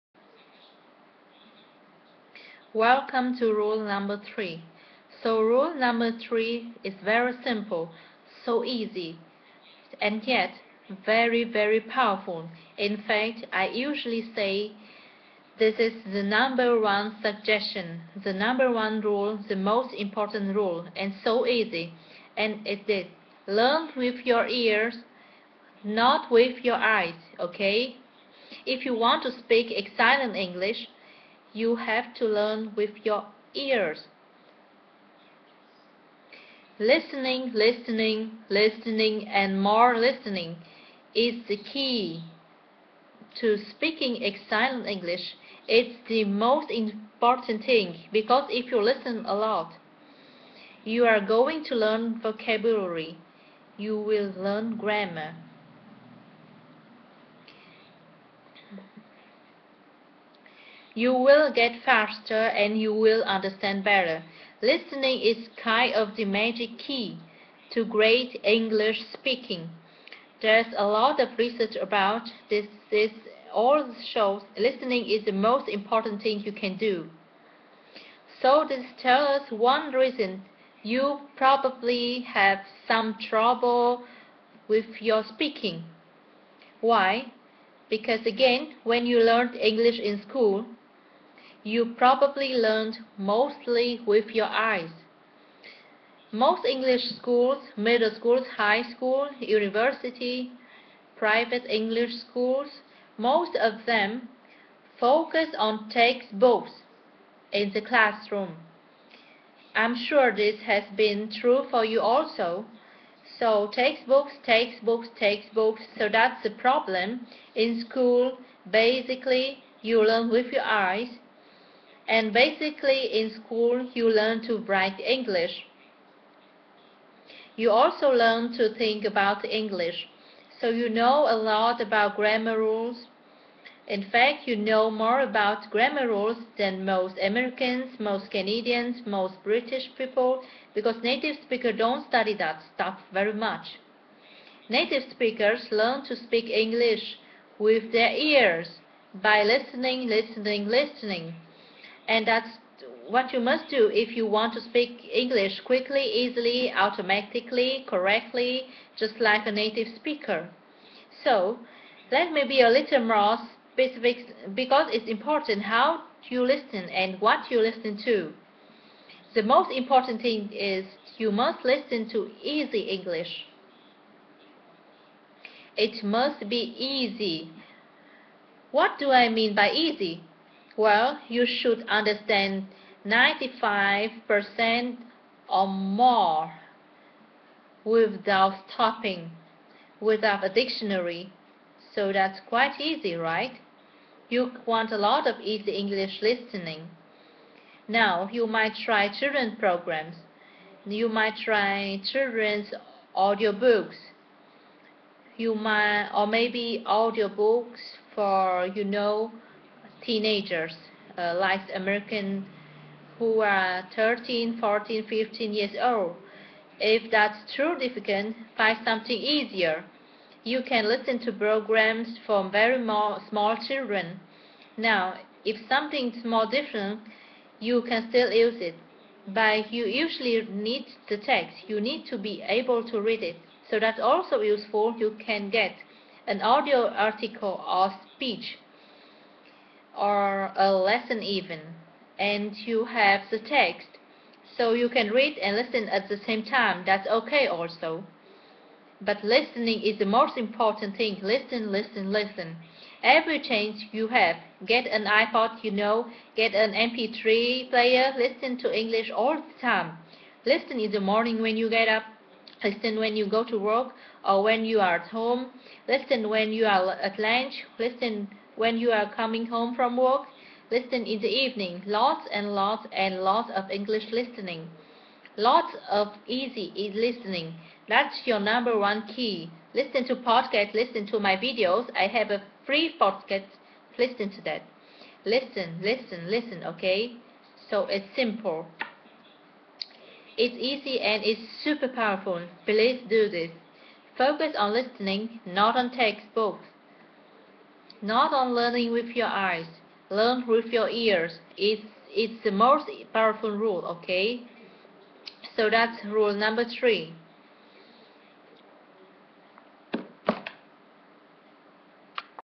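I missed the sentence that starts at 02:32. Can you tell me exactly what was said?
And that's what you must do if you want to speak English quickly, easily, automatically, correctly, just like a native speaker.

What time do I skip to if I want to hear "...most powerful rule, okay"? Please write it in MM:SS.
05:02.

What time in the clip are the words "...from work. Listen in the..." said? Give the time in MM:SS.
04:29.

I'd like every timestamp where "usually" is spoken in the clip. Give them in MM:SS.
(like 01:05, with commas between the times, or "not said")
00:13, 03:49.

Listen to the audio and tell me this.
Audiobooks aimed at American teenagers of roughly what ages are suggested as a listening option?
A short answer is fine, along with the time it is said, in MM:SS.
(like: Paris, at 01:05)
13 to 15, at 03:33.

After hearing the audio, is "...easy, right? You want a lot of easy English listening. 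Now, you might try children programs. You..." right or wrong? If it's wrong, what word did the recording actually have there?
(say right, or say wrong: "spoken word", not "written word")
right.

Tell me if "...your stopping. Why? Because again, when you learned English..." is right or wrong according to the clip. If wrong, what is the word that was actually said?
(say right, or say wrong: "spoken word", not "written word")
wrong: "speaking", not "stopping".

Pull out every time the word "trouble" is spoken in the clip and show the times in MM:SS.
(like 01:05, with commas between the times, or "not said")
01:23.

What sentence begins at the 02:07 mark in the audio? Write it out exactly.
You also learn to think about English, so you know a lot about grammar rules.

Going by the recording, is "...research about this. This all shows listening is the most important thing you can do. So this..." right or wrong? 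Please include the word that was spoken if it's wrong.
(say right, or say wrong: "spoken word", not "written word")
right.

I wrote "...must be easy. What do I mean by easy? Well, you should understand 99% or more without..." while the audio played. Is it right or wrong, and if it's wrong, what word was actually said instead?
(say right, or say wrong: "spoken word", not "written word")
wrong: "95", not "99".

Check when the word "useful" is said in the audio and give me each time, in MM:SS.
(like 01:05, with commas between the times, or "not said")
03:54.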